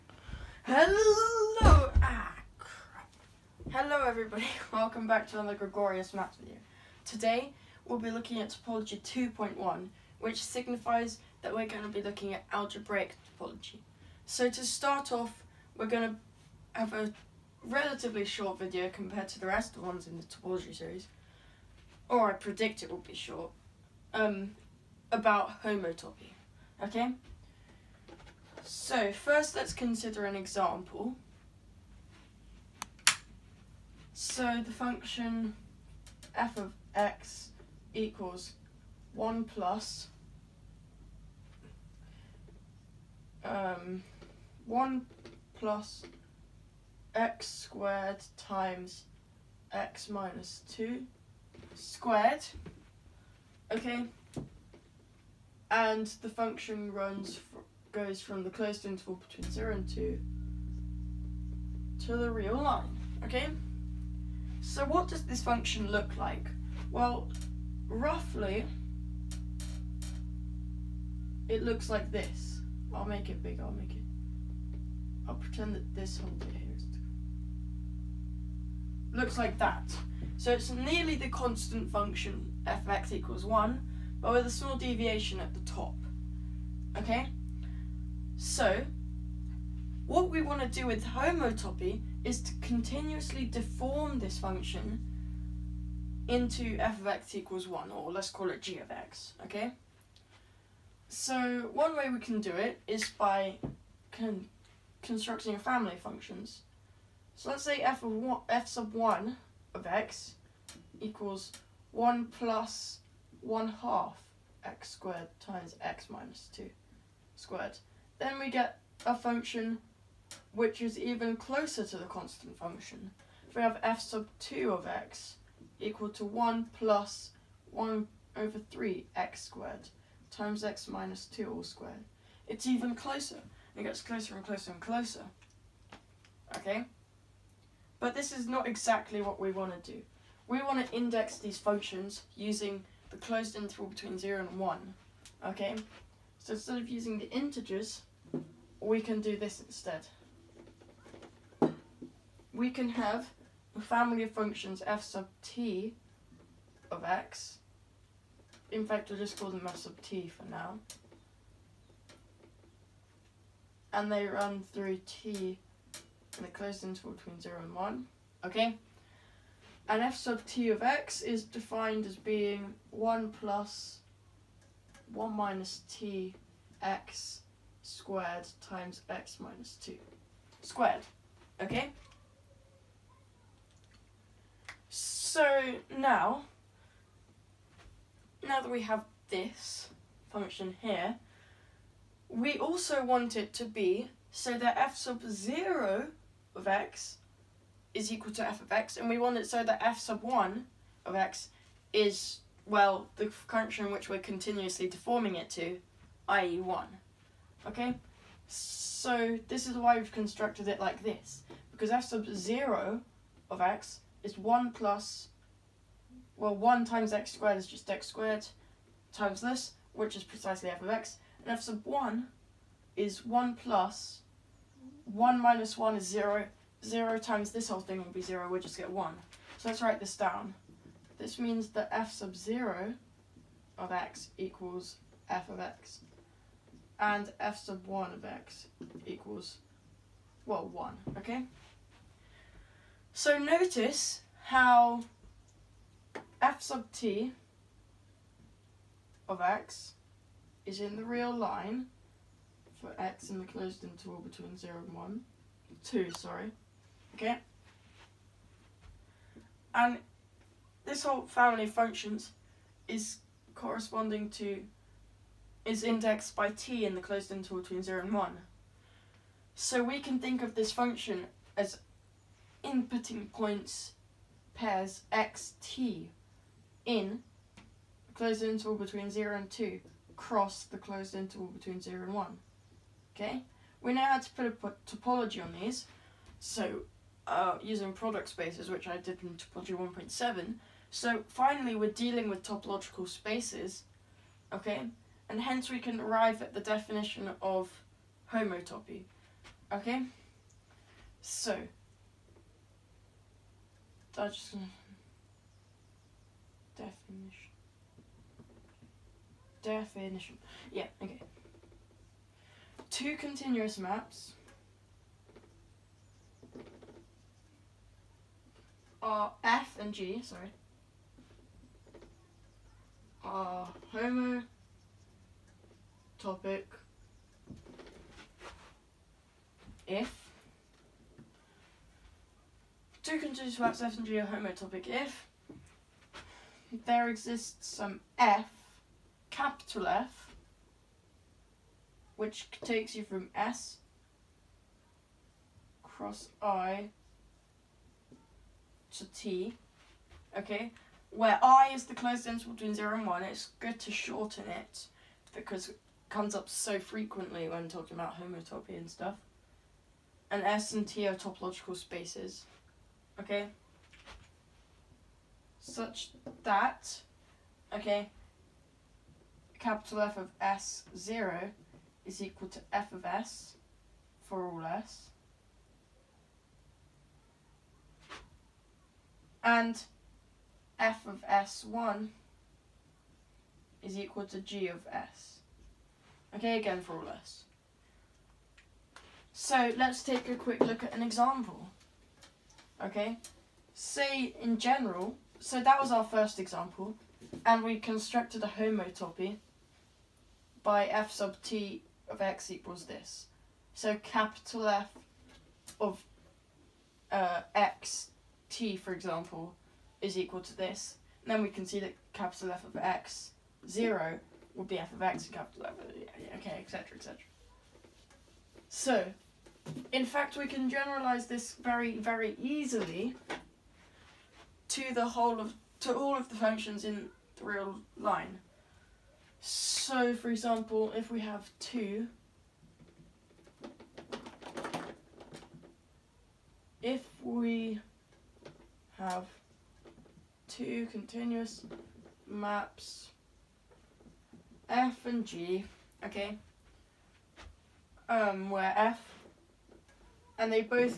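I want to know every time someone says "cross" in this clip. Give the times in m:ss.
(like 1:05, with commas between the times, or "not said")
4:40, 5:45.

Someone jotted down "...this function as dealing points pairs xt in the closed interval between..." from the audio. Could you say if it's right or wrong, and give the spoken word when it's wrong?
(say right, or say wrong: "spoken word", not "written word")
wrong: "inputting", not "dealing".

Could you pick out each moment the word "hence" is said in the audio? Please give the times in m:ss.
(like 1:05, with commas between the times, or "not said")
4:55.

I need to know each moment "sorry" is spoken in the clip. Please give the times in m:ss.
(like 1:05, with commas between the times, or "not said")
4:16, 5:20.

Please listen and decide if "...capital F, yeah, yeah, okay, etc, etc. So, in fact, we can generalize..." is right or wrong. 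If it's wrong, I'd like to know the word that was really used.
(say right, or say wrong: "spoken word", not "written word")
right.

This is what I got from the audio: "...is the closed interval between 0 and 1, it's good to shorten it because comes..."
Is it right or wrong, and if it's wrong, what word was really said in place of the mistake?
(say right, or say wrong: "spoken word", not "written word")
right.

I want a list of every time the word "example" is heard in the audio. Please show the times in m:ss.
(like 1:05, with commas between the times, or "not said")
0:30, 6:31, 6:36, 6:48, 7:10.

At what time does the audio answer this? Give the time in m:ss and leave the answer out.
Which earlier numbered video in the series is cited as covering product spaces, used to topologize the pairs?
4:49.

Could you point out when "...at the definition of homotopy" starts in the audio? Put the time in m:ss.
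4:56.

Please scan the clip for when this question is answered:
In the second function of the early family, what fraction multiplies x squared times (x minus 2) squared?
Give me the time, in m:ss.
2:07.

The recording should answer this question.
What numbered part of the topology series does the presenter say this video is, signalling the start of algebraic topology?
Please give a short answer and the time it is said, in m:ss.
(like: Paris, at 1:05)
2.1, at 0:08.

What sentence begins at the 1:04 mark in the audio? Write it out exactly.
So what does this function look like?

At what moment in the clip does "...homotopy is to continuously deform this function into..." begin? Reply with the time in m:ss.
1:31.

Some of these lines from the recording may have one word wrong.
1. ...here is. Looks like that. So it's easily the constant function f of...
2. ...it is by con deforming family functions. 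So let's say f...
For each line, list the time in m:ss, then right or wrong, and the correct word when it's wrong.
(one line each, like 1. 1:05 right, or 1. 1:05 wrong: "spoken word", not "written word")
1. 1:16 wrong: "nearly", not "easily"
2. 1:42 wrong: "constructing", not "deforming".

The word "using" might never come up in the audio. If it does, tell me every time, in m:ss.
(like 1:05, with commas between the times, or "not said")
2:22, 2:26, 4:47.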